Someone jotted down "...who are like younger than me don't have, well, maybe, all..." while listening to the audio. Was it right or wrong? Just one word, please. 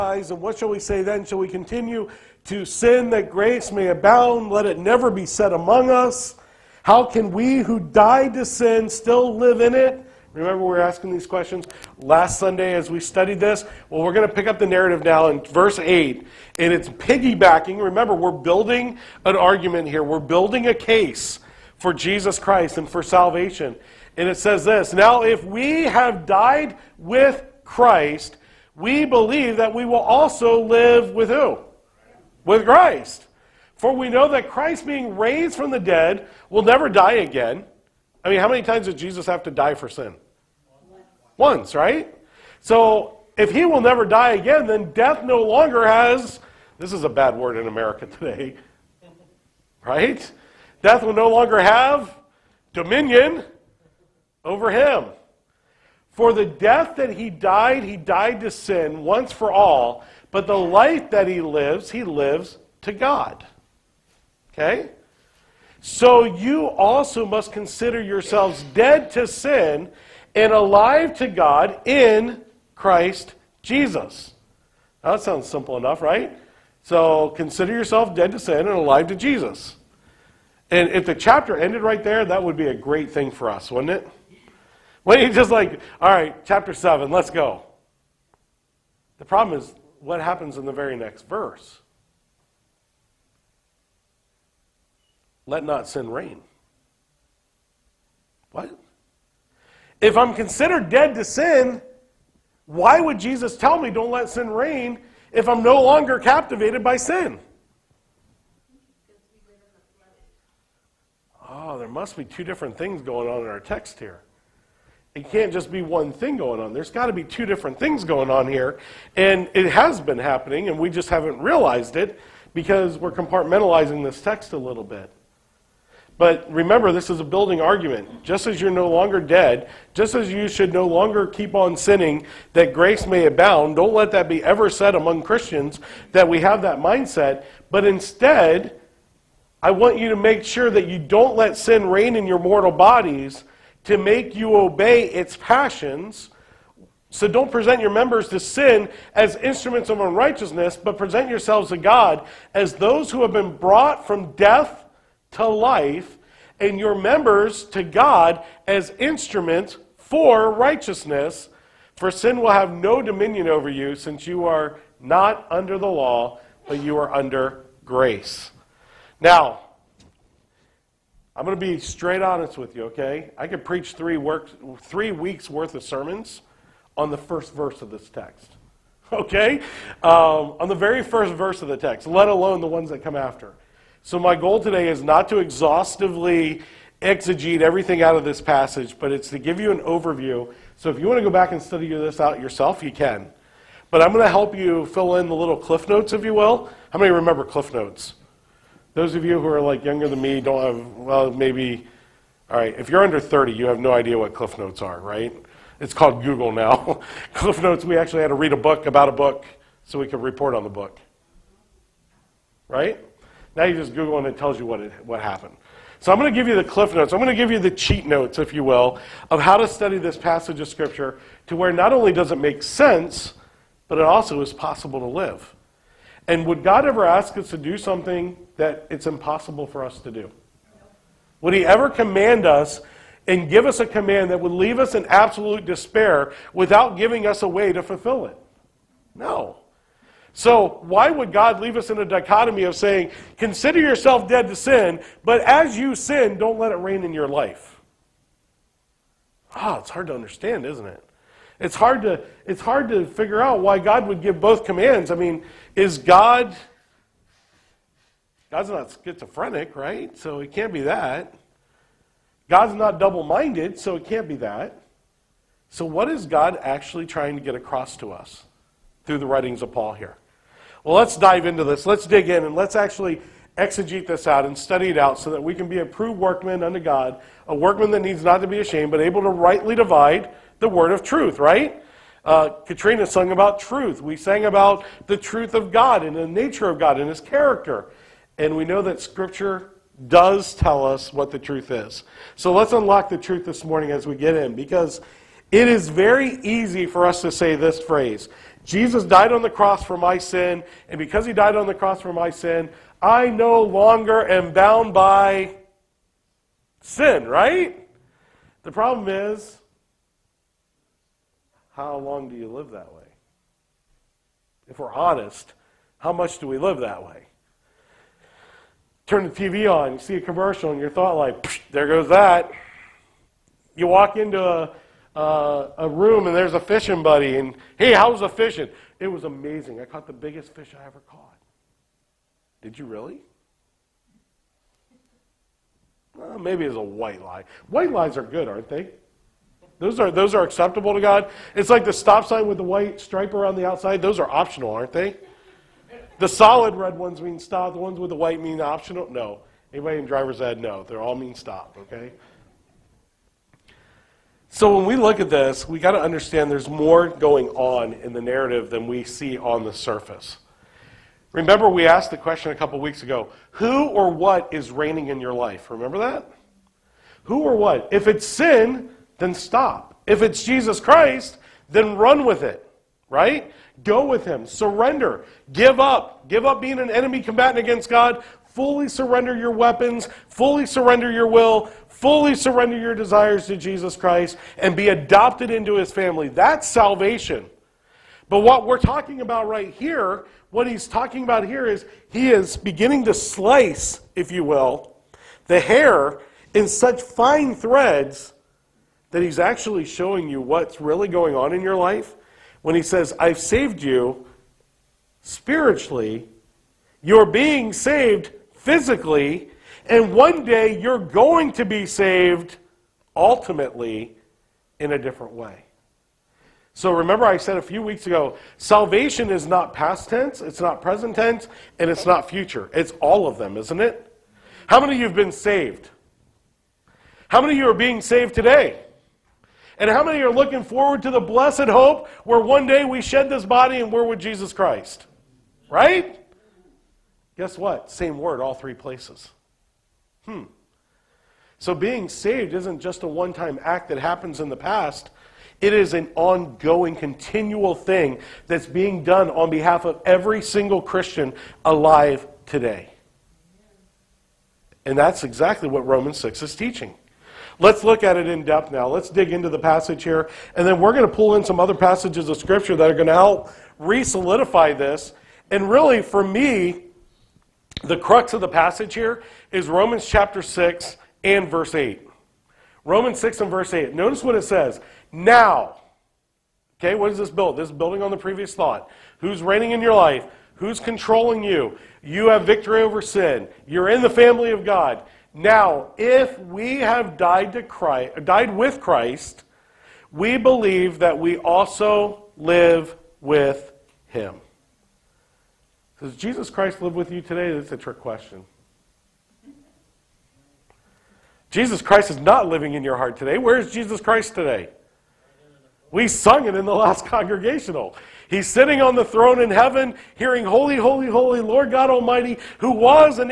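right.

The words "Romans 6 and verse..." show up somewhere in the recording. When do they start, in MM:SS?
07:52.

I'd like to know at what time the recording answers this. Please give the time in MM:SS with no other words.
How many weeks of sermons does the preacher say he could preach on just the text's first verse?
02:54.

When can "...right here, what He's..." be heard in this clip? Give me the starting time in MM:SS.
06:29.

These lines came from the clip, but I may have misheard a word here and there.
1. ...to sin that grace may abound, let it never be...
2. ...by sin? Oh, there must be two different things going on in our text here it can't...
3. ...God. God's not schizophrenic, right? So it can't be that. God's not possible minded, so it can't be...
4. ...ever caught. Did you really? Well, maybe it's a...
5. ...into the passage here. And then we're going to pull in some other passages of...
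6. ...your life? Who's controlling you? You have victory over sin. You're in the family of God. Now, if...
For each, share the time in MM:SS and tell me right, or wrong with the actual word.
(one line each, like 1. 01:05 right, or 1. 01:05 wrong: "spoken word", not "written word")
1. 00:02 right
2. 01:46 right
3. 04:15 wrong: "double", not "possible"
4. 05:30 right
5. 07:39 right
6. 07:59 right.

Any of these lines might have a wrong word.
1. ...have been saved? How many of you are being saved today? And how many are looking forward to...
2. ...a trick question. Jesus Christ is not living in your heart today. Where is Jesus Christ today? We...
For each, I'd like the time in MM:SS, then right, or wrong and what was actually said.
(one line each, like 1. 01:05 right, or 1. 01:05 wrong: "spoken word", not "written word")
1. 07:05 right
2. 08:17 right.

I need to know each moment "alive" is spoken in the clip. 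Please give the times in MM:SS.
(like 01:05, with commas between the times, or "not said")
01:10, 01:18, 07:31.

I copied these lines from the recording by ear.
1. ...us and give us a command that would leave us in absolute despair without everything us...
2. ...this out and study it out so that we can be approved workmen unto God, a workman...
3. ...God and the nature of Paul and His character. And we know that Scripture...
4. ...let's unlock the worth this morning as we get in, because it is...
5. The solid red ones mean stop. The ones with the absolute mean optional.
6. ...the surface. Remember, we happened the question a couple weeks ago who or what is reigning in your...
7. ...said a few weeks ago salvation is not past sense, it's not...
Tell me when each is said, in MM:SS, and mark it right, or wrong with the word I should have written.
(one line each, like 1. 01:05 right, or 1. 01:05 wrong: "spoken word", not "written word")
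1. 03:52 wrong: "giving", not "everything"
2. 04:34 right
3. 04:45 wrong: "God", not "Paul"
4. 04:52 wrong: "truth", not "worth"
5. 05:46 wrong: "white", not "absolute"
6. 05:59 wrong: "asked", not "happened"
7. 06:57 wrong: "tense", not "sense".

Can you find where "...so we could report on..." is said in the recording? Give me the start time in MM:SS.
03:29.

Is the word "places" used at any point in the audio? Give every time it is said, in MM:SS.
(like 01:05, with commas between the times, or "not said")
07:18.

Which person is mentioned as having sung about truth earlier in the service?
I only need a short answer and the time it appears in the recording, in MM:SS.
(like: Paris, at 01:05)
Katrina, at 04:42.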